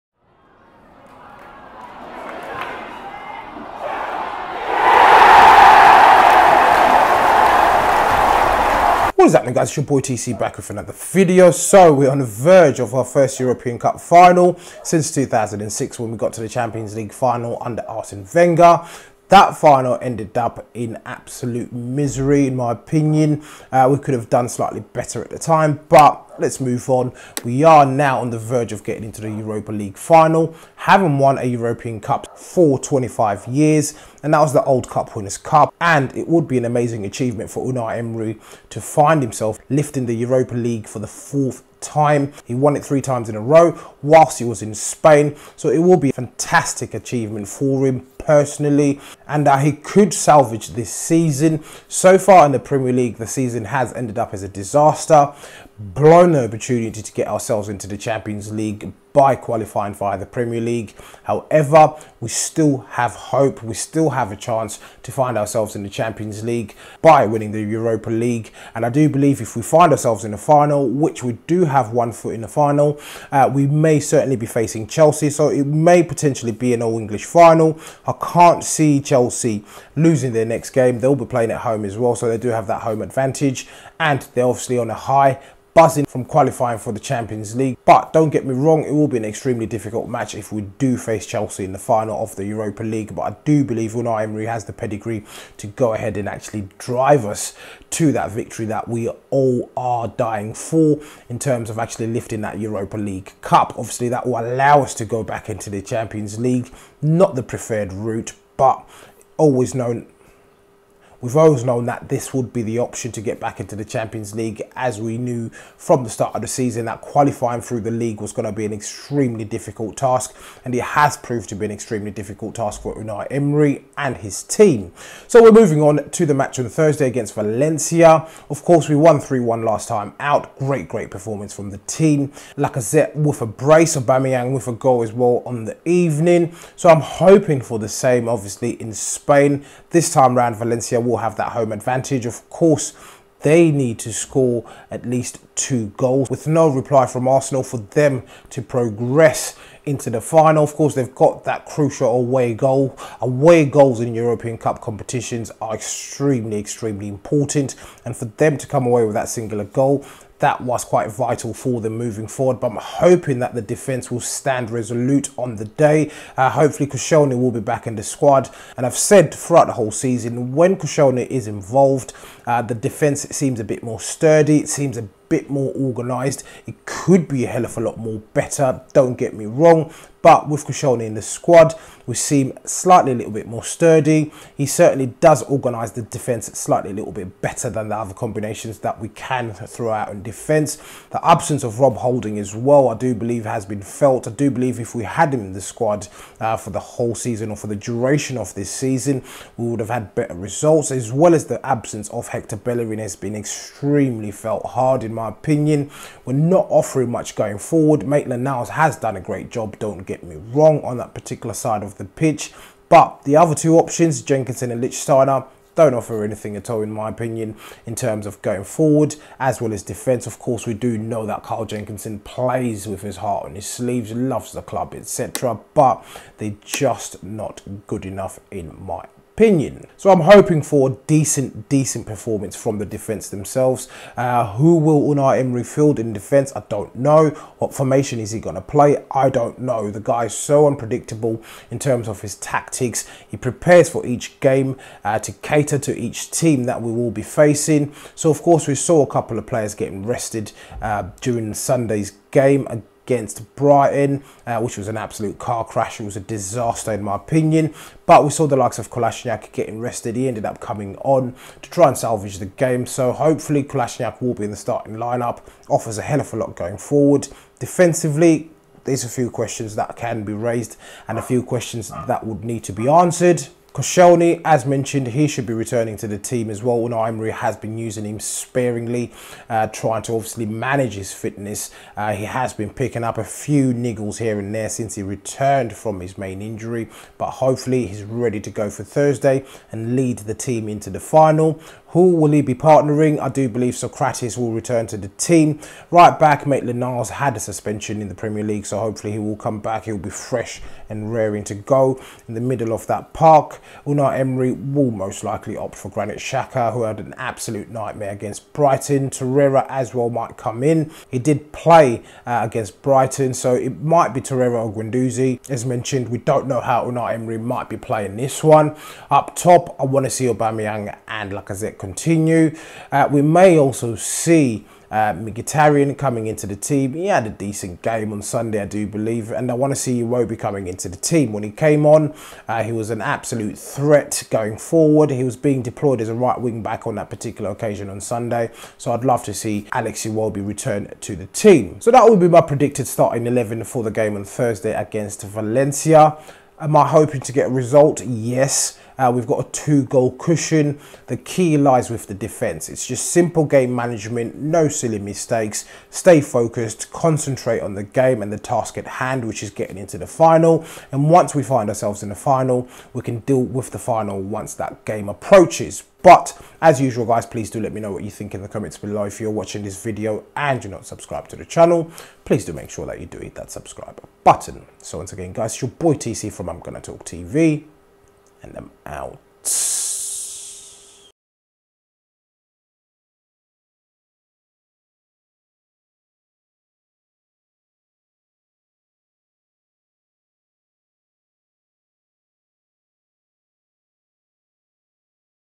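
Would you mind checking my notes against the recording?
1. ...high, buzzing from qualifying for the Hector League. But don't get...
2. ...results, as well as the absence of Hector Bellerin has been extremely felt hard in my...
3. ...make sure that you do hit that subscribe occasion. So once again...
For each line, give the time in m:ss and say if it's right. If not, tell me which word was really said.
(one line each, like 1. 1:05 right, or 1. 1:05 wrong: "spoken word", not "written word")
1. 1:24 wrong: "Champions", not "Hector"
2. 3:20 right
3. 6:12 wrong: "button", not "occasion".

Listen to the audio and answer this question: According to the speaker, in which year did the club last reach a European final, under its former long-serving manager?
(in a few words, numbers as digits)
2006.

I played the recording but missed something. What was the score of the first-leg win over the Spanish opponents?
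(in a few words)
3-1.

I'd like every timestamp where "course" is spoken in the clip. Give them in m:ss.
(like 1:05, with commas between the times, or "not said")
2:08, 2:22, 2:30, 3:40, 4:08.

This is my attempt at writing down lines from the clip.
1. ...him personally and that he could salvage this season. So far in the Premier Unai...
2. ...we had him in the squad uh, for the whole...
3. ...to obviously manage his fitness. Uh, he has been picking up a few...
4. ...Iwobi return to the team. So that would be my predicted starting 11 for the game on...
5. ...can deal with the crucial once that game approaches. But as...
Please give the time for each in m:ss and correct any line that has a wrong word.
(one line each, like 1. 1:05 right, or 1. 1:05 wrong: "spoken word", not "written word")
1. 0:47 wrong: "League", not "Unai"
2. 3:14 right
3. 4:40 right
4. 5:40 right
5. 6:03 wrong: "final", not "crucial".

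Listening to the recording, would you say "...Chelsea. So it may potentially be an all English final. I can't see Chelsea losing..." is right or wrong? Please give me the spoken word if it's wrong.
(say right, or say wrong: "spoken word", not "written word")
right.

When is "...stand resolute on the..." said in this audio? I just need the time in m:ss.
2:44.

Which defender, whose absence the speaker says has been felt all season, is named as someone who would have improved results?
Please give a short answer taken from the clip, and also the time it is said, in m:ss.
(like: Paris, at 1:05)
Rob Holding, at 3:11.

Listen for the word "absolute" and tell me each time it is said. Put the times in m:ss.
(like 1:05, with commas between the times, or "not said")
0:21, 4:14, 5:07, 5:33.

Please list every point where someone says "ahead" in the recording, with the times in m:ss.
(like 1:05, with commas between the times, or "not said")
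1:35.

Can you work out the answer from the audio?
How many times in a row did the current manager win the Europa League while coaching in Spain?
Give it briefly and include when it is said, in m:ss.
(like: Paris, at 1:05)
3, at 0:42.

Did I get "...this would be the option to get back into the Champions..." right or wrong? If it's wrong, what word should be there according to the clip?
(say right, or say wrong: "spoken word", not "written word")
right.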